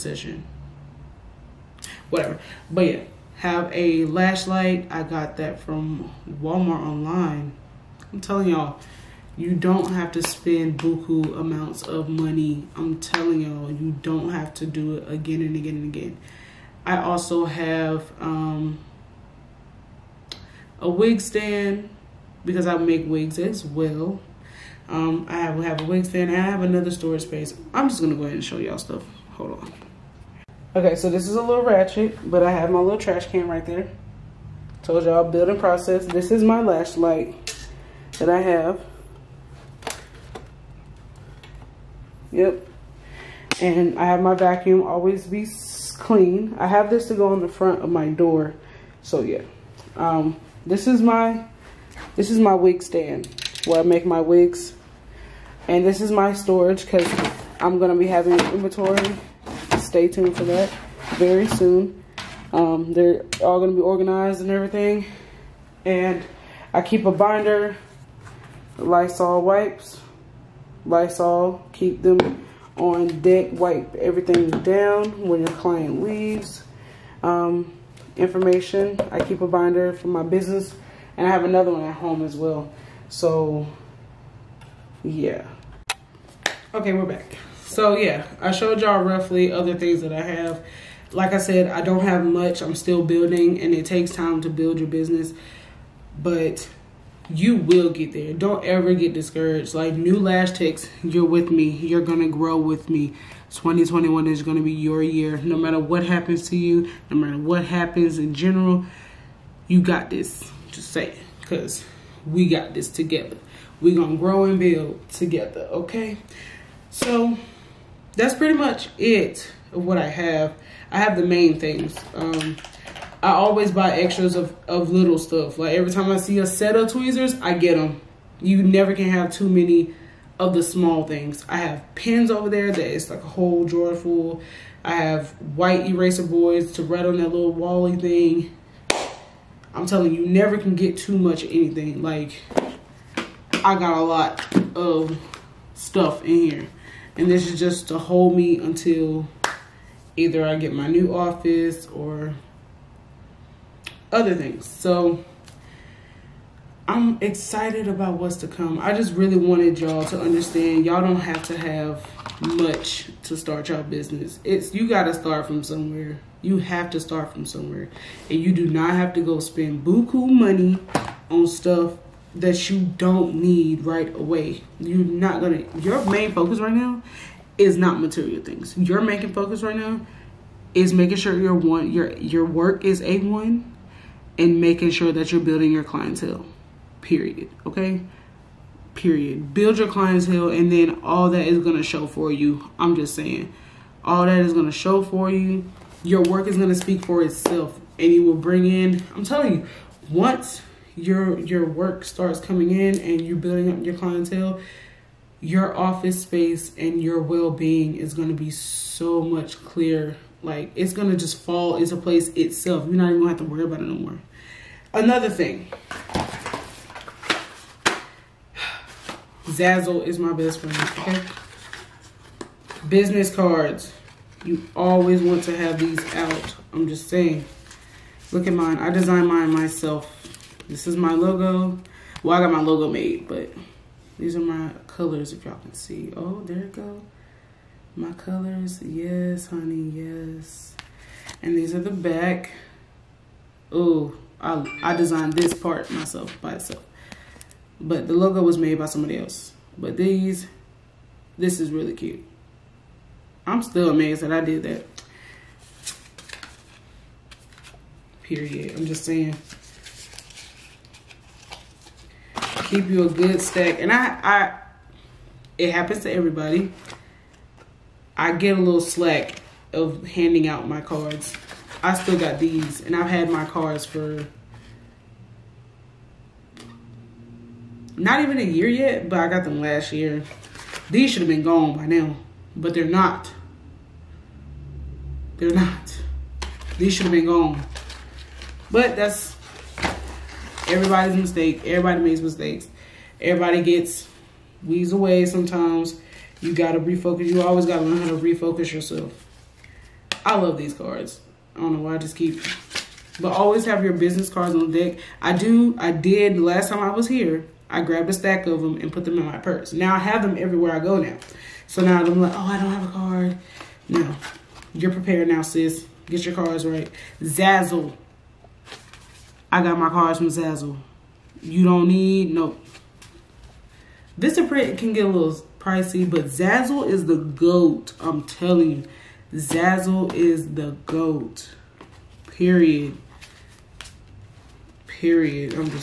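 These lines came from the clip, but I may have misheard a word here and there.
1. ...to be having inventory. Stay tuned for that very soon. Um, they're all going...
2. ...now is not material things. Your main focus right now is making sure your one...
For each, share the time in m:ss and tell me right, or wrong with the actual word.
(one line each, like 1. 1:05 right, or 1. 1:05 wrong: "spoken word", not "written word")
1. 0:57 right
2. 2:56 right.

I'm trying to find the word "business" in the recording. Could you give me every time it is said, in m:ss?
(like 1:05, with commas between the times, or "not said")
1:20, 1:34, 2:43, 3:42, 5:03.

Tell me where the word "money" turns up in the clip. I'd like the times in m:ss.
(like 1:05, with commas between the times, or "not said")
0:12, 2:50.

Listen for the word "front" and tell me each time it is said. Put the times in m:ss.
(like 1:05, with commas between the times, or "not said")
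0:47.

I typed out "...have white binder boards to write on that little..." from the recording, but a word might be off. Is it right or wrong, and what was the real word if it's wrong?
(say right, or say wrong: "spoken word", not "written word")
wrong: "eraser", not "binder".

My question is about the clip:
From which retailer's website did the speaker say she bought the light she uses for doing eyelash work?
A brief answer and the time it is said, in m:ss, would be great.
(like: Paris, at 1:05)
Walmart, at 0:06.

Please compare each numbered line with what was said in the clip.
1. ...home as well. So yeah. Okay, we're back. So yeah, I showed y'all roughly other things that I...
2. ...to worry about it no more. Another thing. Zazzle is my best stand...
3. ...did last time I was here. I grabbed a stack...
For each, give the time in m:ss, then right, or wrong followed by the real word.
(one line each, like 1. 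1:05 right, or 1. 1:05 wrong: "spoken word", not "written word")
1. 1:21 right
2. 3:33 wrong: "friend", not "stand"
3. 5:05 right.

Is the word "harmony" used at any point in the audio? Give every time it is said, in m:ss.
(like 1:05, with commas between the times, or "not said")
not said.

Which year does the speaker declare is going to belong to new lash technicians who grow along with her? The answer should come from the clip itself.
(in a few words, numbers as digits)
2021.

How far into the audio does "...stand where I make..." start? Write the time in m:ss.
0:52.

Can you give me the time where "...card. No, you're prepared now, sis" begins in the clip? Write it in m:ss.
5:12.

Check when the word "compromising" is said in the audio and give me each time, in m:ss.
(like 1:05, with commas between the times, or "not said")
not said.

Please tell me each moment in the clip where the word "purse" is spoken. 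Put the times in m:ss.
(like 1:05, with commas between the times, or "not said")
5:09.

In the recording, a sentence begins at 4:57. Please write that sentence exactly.
You always gotta learn how to refocus yourself.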